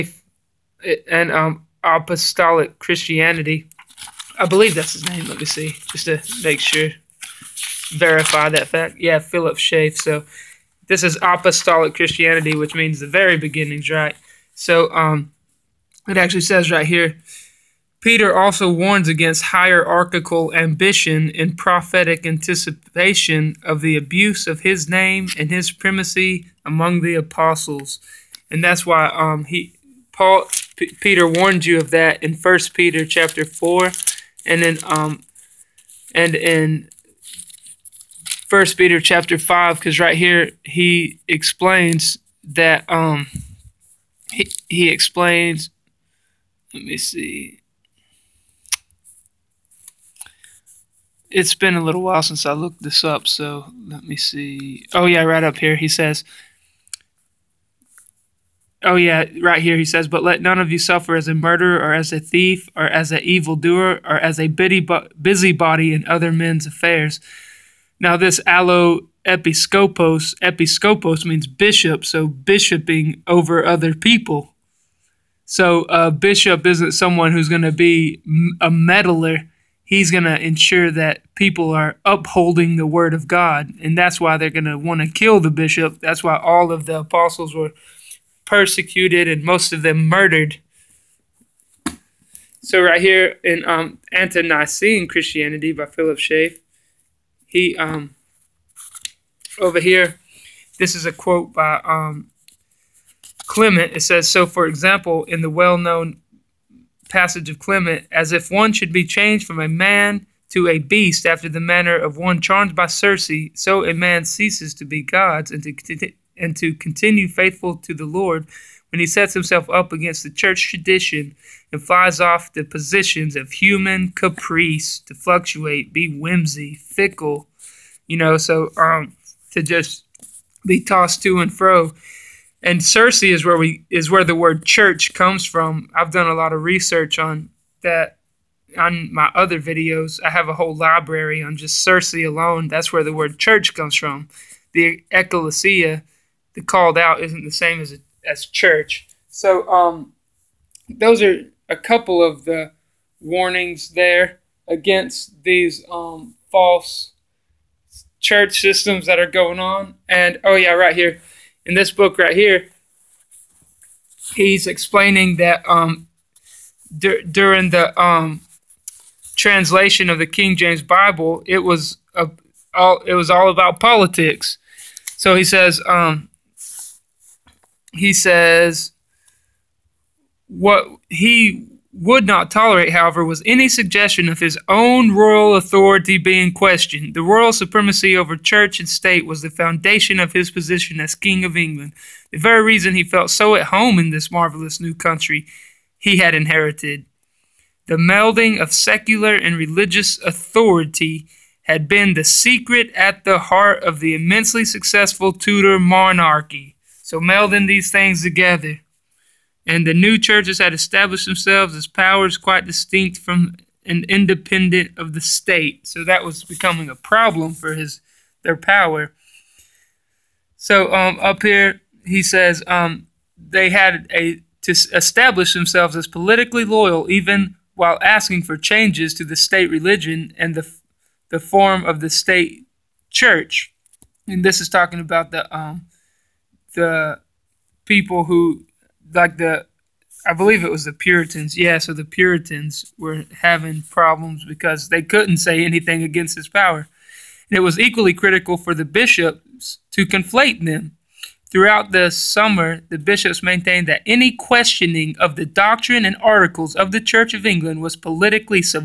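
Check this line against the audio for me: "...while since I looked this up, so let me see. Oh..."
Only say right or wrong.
right.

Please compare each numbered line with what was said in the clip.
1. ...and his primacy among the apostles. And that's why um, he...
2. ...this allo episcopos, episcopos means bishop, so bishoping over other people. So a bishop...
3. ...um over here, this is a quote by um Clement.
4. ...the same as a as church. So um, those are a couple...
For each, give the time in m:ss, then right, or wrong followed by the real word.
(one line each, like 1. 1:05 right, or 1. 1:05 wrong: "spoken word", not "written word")
1. 0:25 right
2. 1:08 right
3. 1:37 right
4. 2:27 right.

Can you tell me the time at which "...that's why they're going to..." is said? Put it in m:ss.
1:23.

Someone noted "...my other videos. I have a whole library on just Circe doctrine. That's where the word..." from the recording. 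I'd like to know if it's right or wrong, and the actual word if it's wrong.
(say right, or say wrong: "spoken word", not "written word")
wrong: "alone", not "doctrine".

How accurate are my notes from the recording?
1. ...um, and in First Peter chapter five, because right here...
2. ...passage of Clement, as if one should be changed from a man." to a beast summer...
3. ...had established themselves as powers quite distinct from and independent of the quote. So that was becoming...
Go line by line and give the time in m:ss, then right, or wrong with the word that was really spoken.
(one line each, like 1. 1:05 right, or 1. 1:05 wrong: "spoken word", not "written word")
1. 0:34 right
2. 1:47 wrong: "after", not "summer"
3. 3:30 wrong: "state", not "quote".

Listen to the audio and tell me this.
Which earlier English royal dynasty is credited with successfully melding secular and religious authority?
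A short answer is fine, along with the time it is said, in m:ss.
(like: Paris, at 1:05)
Tudor, at 3:25.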